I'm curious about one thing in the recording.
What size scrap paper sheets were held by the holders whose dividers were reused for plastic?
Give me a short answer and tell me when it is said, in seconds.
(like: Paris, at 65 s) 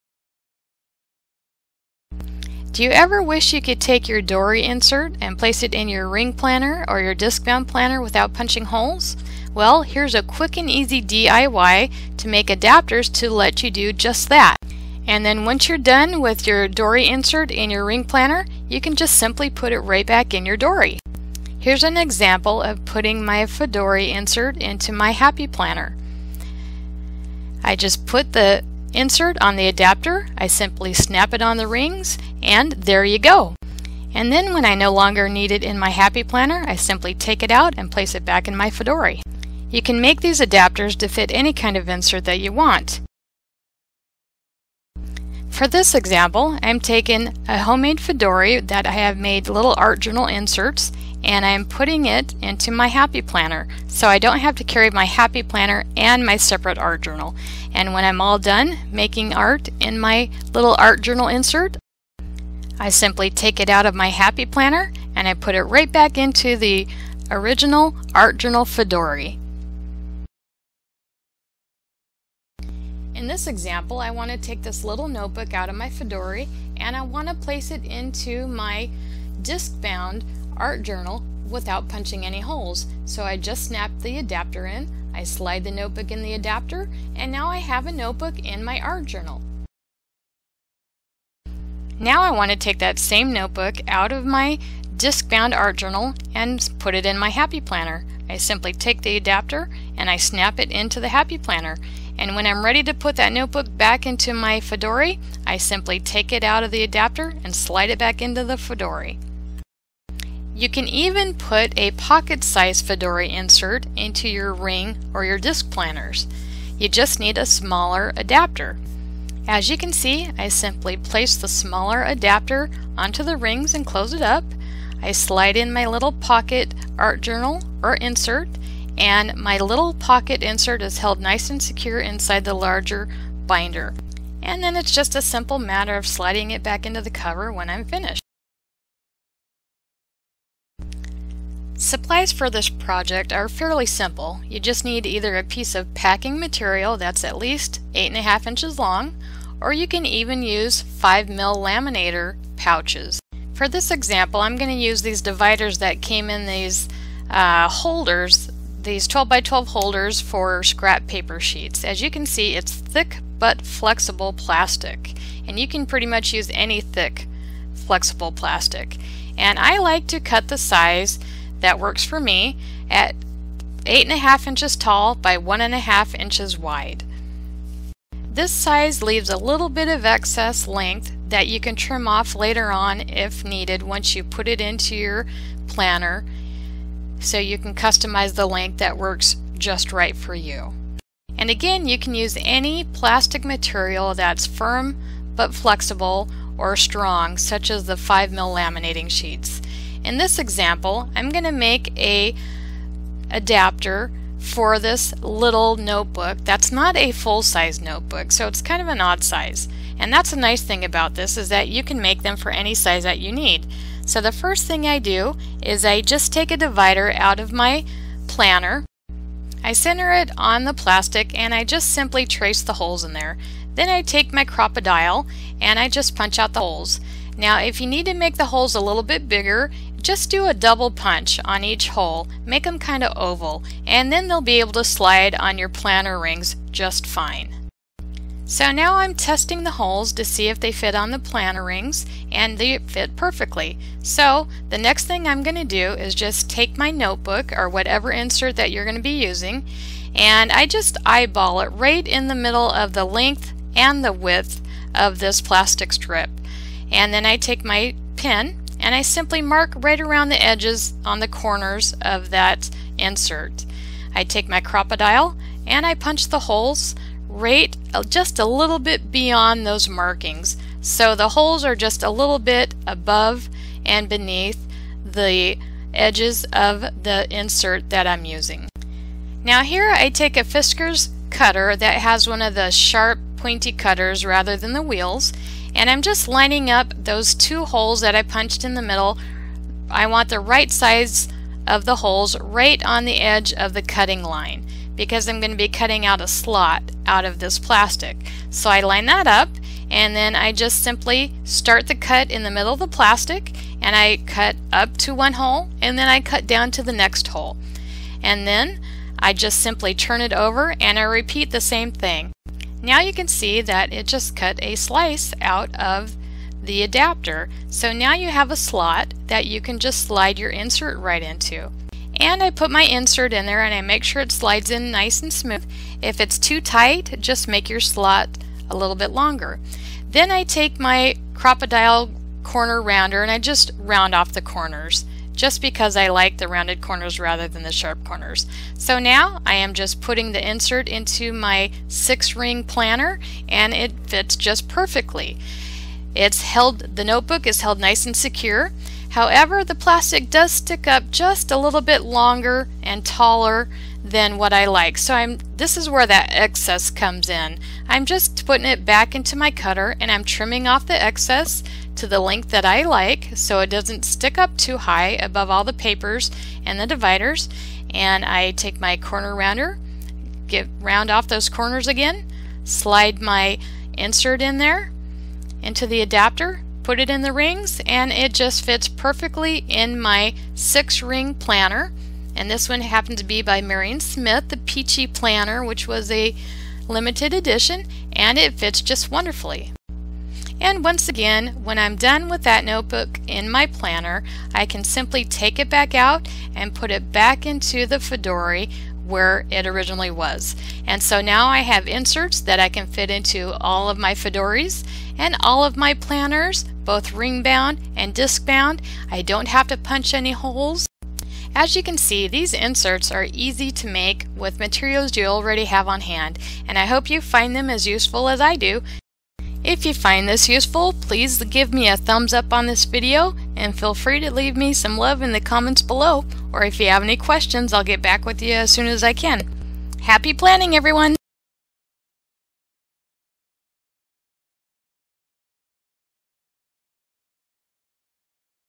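12 by 12, at 159 s.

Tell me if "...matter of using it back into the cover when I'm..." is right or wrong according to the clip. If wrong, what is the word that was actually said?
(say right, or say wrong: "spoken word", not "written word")
wrong: "sliding", not "using".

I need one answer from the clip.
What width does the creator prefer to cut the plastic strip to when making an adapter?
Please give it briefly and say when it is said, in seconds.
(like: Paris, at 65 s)
1.5 inches, at 175 s.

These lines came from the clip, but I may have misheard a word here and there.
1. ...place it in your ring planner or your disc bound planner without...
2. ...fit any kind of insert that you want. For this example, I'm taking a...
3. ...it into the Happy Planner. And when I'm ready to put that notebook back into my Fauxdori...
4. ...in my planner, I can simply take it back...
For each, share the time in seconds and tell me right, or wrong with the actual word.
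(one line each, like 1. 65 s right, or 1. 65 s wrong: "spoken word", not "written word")
1. 5 s right
2. 41 s right
3. 100 s right
4. 393 s right.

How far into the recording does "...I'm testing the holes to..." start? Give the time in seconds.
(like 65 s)
238 s.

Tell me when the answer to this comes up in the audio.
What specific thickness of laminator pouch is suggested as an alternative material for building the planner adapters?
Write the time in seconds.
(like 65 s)
150 s.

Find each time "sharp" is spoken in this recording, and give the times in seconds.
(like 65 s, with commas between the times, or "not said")
282 s, 337 s.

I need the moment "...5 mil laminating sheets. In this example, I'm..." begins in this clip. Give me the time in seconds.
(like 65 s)
197 s.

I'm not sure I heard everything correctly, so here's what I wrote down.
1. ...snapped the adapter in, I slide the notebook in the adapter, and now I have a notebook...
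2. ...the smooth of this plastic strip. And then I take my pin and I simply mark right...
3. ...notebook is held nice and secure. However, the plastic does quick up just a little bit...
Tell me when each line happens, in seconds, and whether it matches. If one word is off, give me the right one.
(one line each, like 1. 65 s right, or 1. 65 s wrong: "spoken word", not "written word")
1. 83 s right
2. 254 s wrong: "width", not "smooth"
3. 347 s wrong: "stick", not "quick".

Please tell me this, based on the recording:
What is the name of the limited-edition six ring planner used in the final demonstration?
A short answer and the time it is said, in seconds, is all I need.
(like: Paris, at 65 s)
Peachy Planner, at 384 s.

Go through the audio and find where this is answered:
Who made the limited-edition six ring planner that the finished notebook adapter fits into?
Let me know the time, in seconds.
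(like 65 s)
383 s.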